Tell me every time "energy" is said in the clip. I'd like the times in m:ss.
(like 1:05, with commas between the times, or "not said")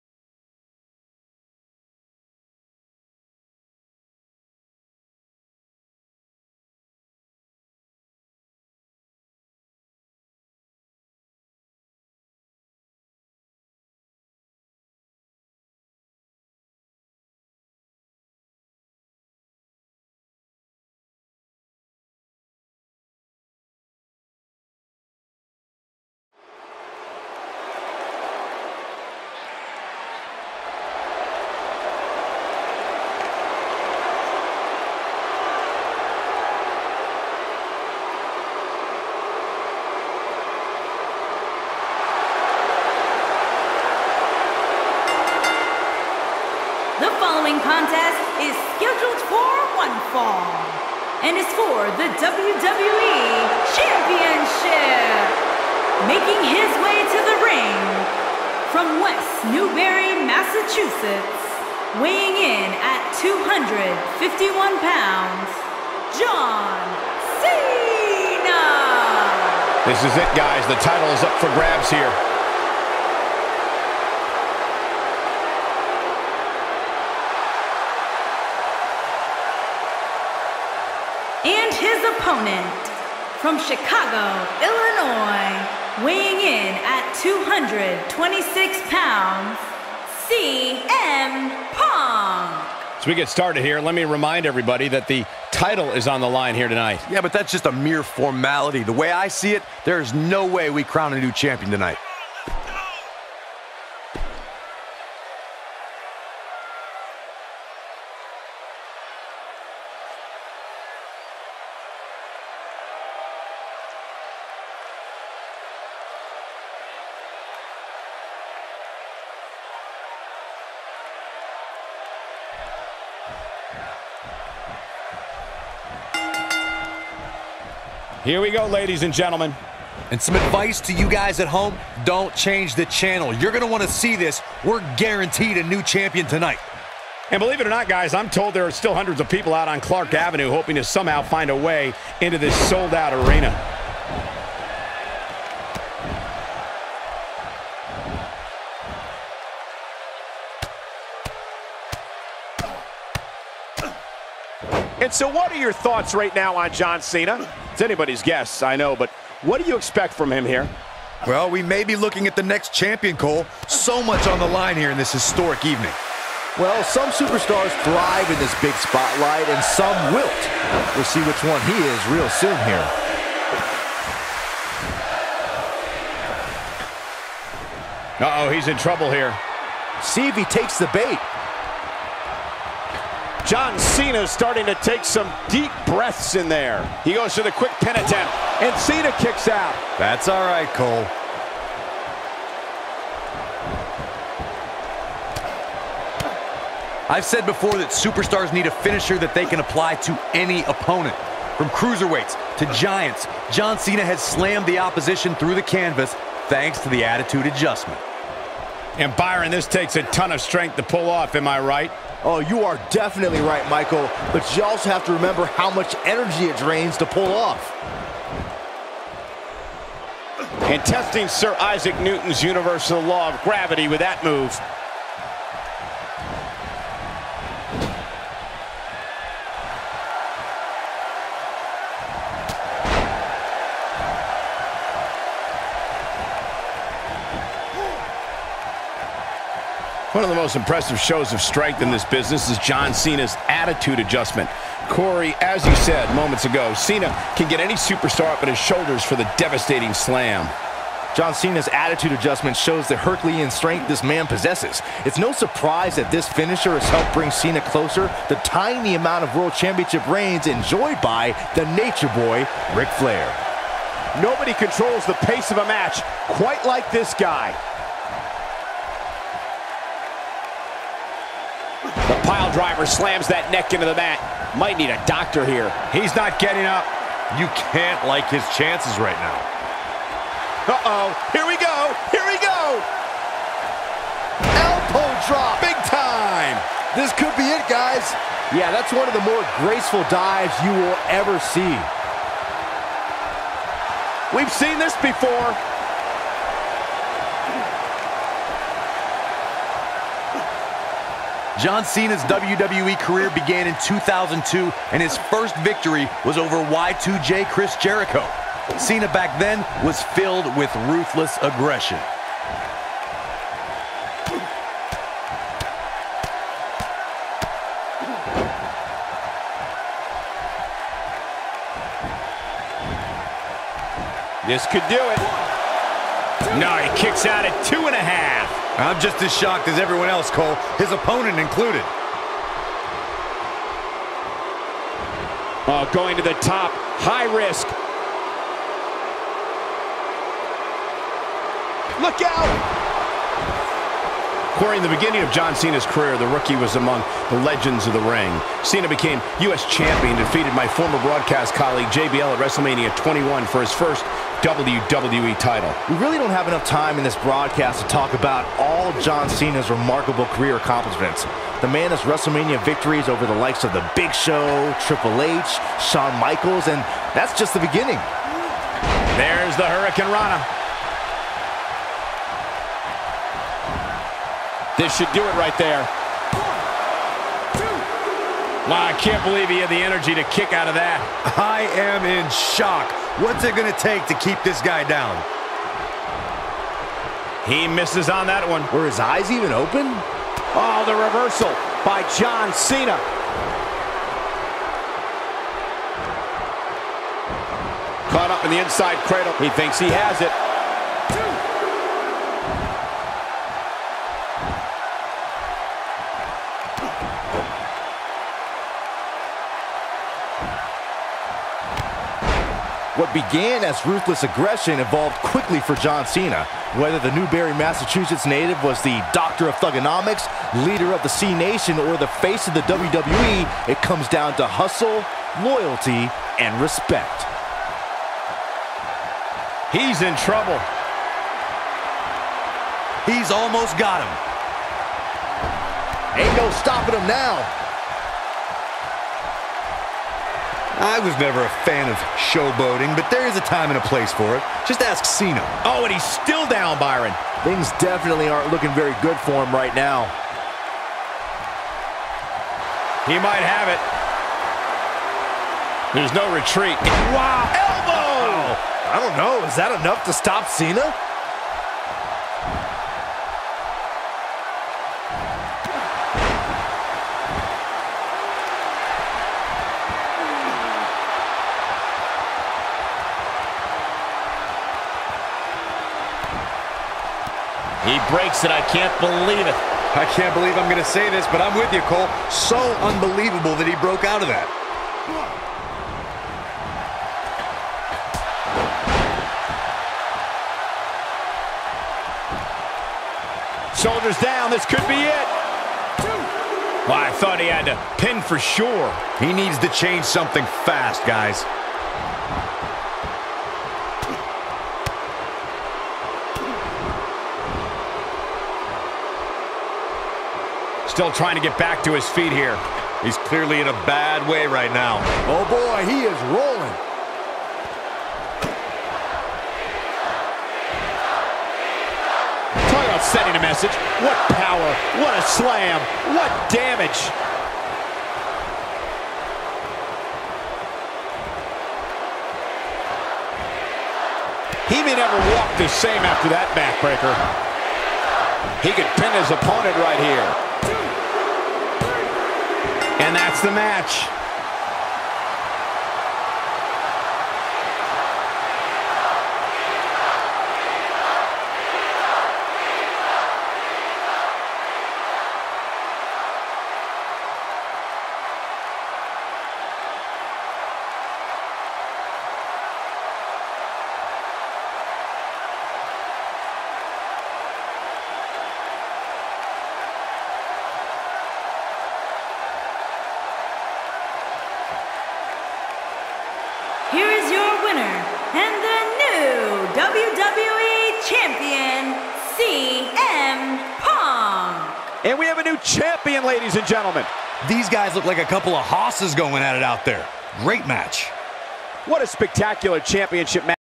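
3:36, 6:19.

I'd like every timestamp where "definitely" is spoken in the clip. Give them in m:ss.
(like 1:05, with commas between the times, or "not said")
3:32, 7:27.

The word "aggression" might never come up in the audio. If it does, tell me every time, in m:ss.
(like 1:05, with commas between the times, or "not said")
5:11, 6:54.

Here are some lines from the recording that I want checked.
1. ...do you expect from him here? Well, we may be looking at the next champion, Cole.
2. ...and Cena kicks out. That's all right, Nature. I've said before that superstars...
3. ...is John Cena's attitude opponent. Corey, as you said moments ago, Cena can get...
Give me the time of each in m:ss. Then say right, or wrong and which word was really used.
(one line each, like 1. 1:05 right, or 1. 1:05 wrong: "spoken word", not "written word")
1. 2:39 right
2. 3:08 wrong: "Cole", not "Nature"
3. 4:02 wrong: "adjustment", not "opponent".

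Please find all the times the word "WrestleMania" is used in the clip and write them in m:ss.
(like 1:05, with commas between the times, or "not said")
5:52, 6:02.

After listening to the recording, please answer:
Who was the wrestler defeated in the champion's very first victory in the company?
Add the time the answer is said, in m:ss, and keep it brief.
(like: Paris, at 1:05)
Chris Jericho, at 5:06.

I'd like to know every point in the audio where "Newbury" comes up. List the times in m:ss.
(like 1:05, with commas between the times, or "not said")
0:59, 6:57.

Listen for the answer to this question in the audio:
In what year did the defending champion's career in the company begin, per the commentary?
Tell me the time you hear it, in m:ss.
5:03.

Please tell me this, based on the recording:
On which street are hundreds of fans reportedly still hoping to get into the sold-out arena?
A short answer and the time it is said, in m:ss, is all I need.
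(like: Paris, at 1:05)
Clark Avenue, at 2:19.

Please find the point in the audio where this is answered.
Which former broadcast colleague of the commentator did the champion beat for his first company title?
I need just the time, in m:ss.
5:51.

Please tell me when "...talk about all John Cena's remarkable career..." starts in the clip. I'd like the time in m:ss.
5:57.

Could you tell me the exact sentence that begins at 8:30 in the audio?
Still trying to get back to his feet here.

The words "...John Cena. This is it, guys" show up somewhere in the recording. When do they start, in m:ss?
1:06.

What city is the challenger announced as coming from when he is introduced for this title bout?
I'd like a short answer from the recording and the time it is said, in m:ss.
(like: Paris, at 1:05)
Chicago, Illinois, at 1:23.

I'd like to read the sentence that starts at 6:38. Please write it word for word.
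Caught up in the inside cradle.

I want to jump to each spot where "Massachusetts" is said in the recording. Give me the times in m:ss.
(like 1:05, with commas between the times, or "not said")
1:00, 6:57.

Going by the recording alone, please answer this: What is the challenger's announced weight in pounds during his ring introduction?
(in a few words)
226.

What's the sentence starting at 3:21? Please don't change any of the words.
From cruiserweights to giants, John Cena has slammed the opposition through the canvas thanks to the attitude adjustment.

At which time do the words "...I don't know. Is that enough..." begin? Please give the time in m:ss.
7:38.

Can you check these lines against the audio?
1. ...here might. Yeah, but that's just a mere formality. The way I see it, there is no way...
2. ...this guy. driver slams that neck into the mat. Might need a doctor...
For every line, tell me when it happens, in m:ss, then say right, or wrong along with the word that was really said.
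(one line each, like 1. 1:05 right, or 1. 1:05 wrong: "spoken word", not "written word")
1. 1:36 wrong: "tonight", not "might"
2. 4:26 right.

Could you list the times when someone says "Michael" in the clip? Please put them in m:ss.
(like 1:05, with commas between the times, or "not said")
3:33, 6:06.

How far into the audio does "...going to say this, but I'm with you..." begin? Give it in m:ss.
8:00.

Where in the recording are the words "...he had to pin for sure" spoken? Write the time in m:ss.
8:17.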